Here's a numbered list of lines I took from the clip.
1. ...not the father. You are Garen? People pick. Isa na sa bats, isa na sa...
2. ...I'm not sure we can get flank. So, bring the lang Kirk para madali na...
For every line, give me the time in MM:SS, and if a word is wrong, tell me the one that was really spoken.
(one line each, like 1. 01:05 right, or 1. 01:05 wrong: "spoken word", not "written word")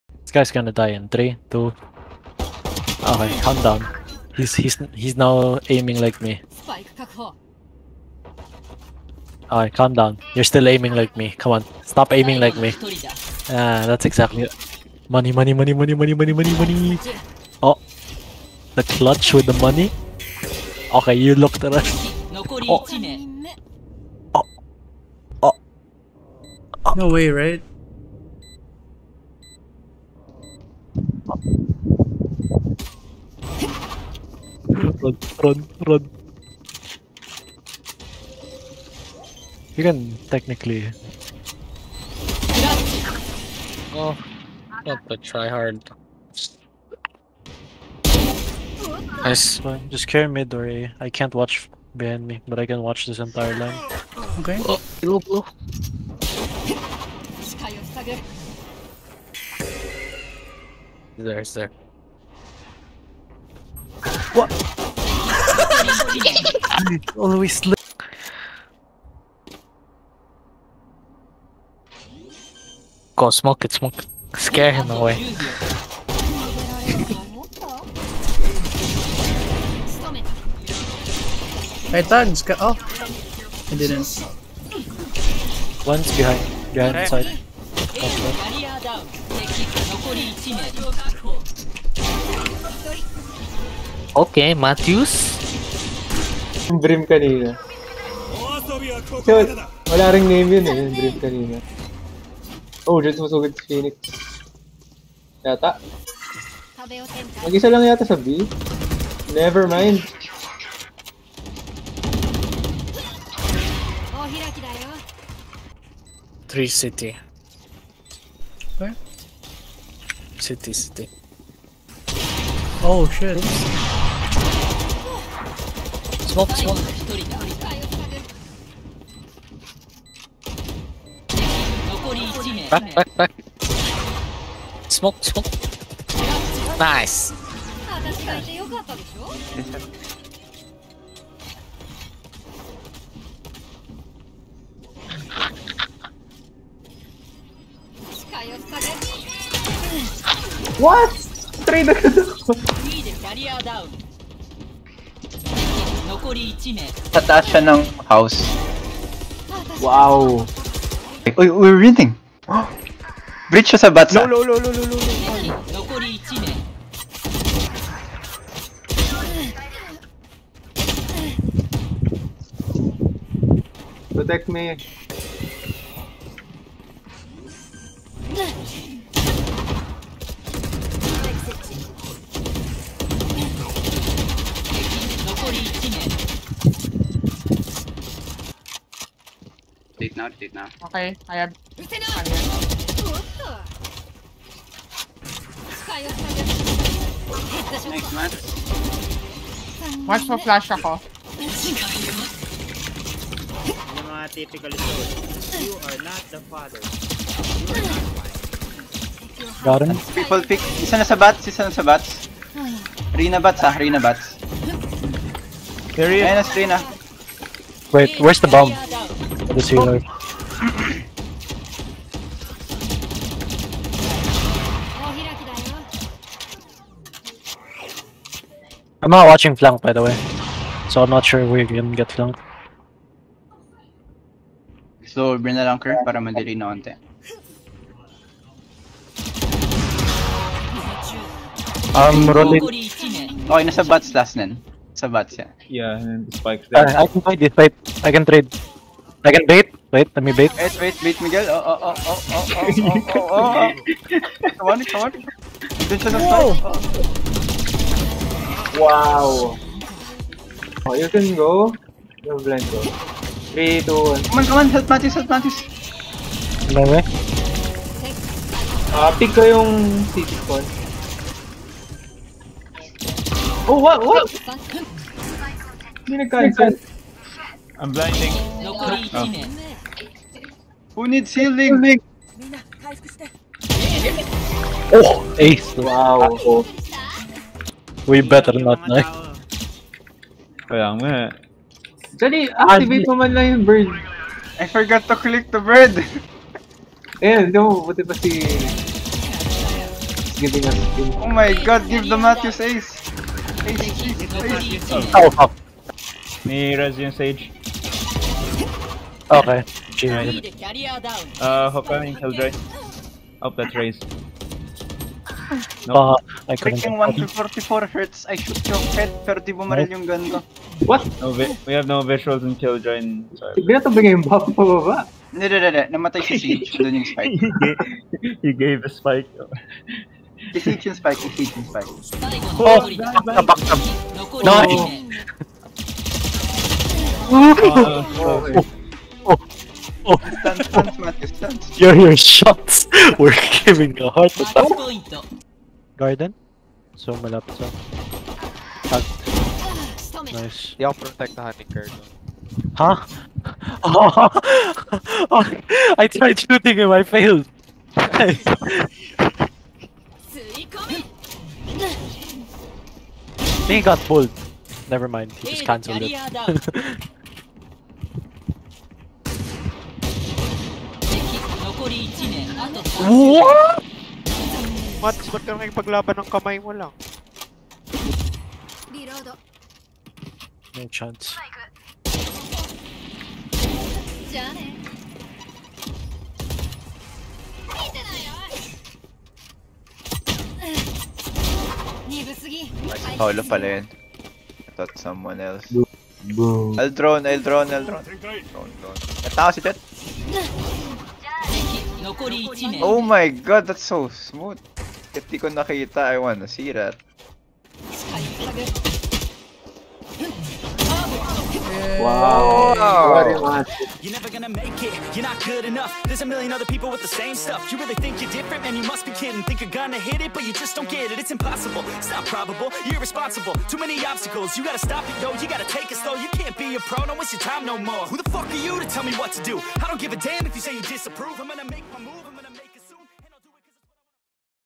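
1. 03:26 right
2. 03:51 right.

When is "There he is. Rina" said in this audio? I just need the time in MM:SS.
03:35.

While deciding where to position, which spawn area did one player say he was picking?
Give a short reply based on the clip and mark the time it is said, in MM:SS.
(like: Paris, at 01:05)
city spawn, at 04:30.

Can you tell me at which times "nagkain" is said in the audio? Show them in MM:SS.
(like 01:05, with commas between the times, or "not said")
04:36.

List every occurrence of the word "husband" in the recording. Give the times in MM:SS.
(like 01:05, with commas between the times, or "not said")
not said.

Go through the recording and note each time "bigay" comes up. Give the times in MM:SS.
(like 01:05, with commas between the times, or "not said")
05:23.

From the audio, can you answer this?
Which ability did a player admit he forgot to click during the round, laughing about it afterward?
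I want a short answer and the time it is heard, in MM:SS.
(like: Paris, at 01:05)
the bird, at 04:54.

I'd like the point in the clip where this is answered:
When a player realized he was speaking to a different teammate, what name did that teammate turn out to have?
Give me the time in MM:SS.
06:33.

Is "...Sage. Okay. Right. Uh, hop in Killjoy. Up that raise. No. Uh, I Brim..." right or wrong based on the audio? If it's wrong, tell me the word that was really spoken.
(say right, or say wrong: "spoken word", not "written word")
wrong: "Freaking", not "Brim".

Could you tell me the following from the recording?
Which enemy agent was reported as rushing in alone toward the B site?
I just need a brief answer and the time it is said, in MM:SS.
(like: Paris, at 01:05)
Phoenix, at 01:43.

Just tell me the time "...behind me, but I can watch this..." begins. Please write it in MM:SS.
00:51.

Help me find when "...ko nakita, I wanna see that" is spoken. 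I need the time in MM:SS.
06:45.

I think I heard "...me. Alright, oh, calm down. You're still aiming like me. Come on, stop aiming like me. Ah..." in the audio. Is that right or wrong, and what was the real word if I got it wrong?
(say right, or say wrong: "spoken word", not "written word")
right.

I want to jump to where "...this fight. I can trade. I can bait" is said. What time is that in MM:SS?
04:07.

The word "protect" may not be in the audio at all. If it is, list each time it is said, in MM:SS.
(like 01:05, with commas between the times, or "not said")
02:54, 05:51.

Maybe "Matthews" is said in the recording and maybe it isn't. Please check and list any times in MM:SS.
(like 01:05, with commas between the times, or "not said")
01:34, 05:02.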